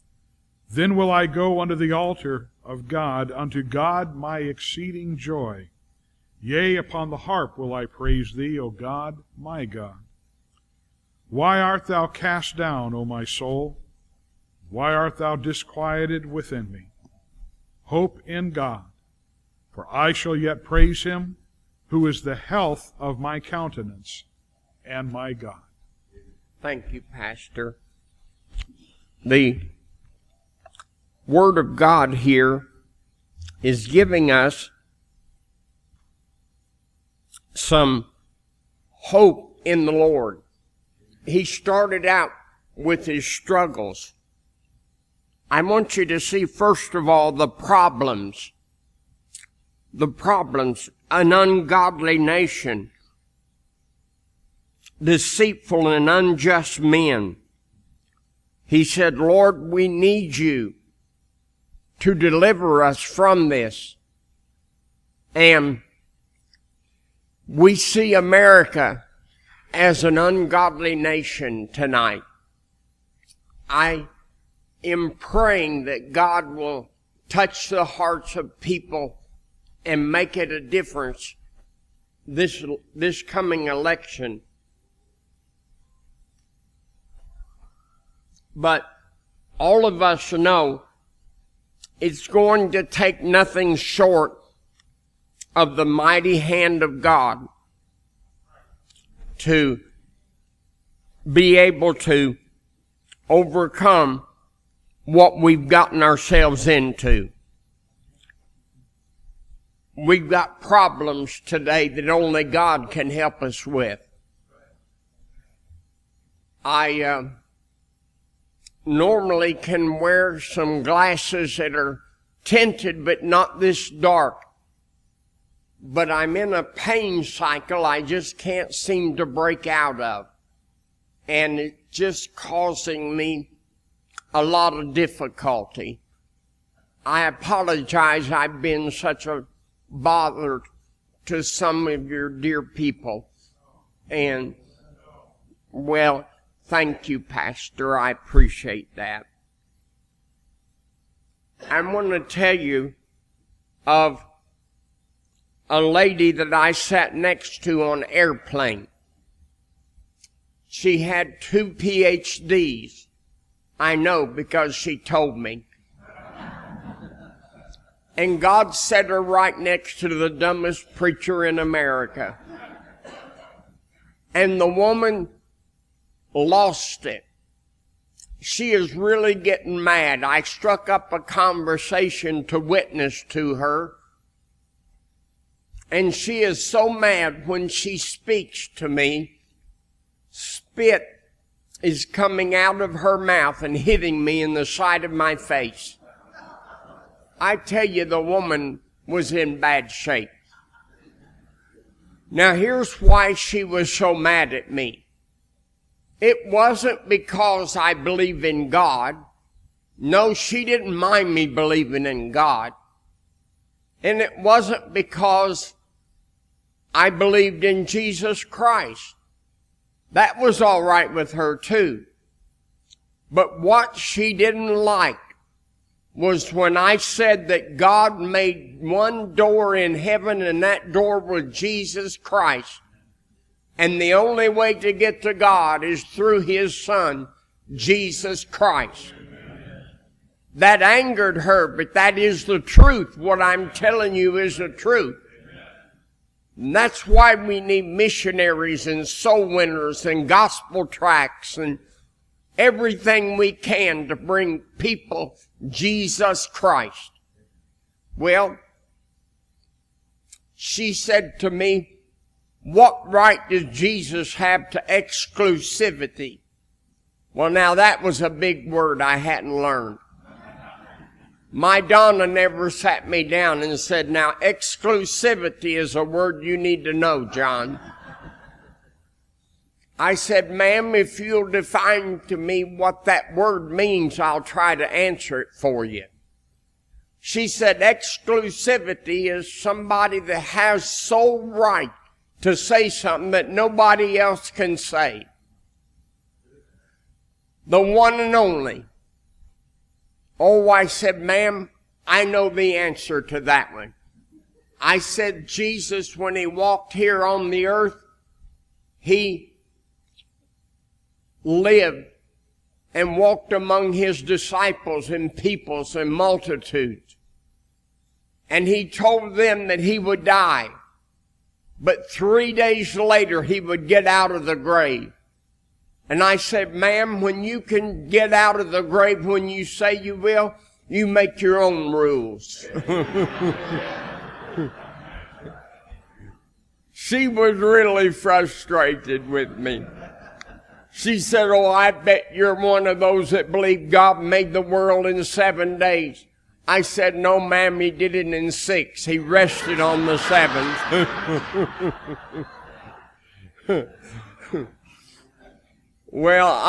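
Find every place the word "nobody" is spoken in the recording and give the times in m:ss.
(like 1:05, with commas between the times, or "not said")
4:53.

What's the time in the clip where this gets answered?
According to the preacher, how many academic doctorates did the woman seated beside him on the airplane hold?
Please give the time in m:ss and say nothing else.
2:41.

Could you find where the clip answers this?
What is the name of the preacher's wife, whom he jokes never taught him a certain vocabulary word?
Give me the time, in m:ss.
4:31.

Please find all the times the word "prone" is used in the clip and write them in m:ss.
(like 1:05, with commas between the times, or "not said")
not said.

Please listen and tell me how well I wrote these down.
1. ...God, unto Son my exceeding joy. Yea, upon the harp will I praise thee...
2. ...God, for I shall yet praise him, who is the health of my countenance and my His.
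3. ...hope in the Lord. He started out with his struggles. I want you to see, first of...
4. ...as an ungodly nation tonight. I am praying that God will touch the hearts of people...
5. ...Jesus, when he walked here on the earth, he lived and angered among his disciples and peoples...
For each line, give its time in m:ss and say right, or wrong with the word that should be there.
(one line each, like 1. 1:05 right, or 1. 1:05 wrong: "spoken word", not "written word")
1. 0:02 wrong: "God", not "Son"
2. 0:18 wrong: "God", not "His"
3. 0:38 right
4. 1:09 right
5. 5:05 wrong: "walked", not "angered".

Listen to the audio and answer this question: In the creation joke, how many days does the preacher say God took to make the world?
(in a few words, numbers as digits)
6.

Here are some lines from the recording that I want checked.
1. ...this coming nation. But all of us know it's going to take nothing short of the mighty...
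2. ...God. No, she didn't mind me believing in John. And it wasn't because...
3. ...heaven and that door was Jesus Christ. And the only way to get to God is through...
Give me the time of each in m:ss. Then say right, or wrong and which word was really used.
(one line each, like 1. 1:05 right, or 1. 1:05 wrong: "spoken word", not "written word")
1. 1:22 wrong: "election", not "nation"
2. 3:28 wrong: "God", not "John"
3. 3:49 right.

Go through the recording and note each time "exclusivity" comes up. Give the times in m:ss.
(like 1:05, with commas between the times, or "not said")
4:24, 4:34, 4:47.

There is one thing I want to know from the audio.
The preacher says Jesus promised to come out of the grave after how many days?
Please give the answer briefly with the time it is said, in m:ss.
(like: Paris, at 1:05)
3, at 5:22.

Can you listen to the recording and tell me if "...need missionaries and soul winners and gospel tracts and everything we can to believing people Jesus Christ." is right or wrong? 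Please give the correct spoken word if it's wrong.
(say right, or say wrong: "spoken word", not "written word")
wrong: "bring", not "believing".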